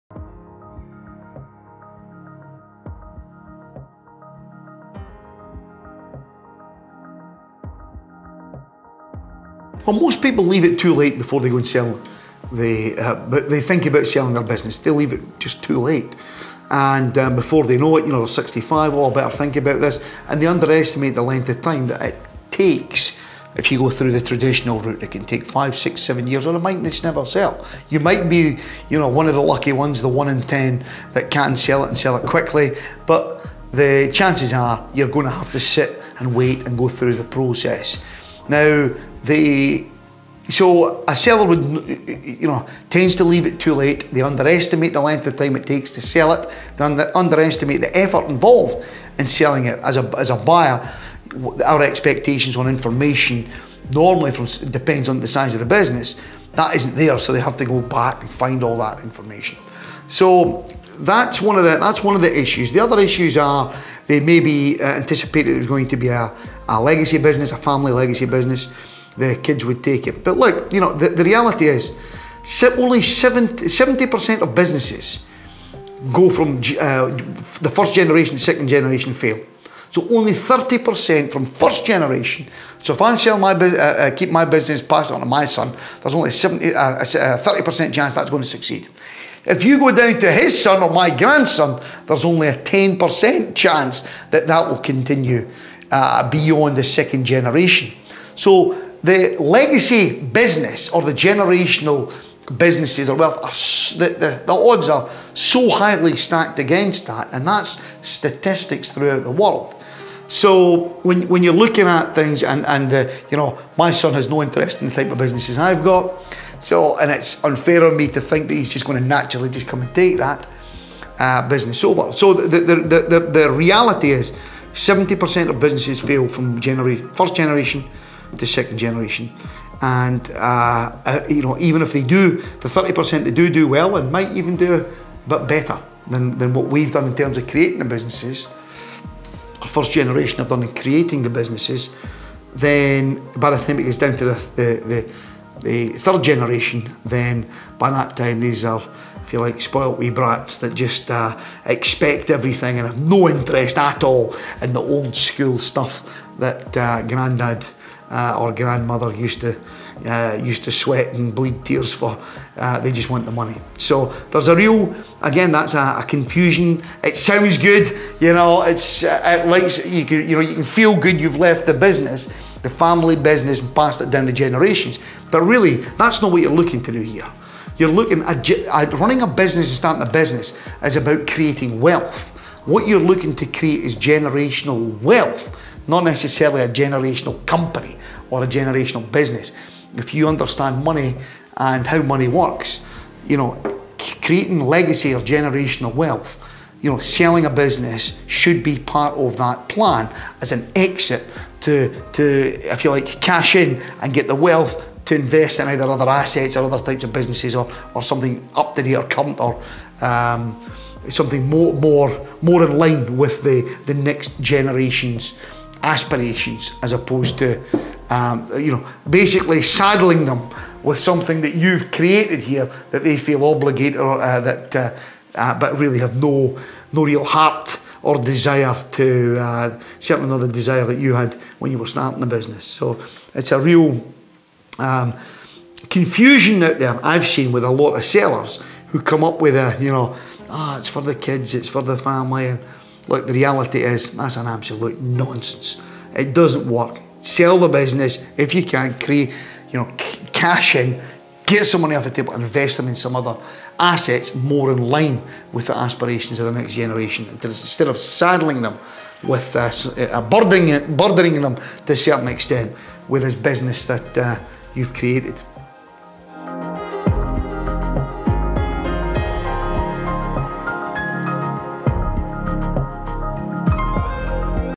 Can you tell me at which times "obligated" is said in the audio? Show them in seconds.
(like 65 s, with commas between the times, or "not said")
223 s.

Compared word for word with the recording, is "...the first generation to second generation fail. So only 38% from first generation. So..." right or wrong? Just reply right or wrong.
wrong.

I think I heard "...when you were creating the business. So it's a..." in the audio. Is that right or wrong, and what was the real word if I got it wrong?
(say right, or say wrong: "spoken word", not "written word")
wrong: "starting", not "creating".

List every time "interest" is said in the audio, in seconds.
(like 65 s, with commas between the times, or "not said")
114 s, 153 s.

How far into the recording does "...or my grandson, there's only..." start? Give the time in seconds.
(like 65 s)
90 s.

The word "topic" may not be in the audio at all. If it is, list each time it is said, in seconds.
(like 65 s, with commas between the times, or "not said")
not said.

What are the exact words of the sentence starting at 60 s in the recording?
So that's one of the that's one of the issues.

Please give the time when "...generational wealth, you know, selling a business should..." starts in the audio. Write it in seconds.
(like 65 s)
195 s.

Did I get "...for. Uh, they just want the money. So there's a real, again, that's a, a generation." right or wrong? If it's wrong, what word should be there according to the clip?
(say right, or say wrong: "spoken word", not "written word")
wrong: "confusion", not "generation".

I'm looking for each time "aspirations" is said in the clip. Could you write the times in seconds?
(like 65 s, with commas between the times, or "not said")
215 s, 255 s.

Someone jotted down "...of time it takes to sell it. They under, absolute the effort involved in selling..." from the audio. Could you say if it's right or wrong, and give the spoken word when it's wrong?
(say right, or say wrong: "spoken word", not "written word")
wrong: "underestimate", not "absolute".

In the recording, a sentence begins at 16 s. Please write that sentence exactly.
And um, before they know it, you know, they're 65, oh, I better think about this.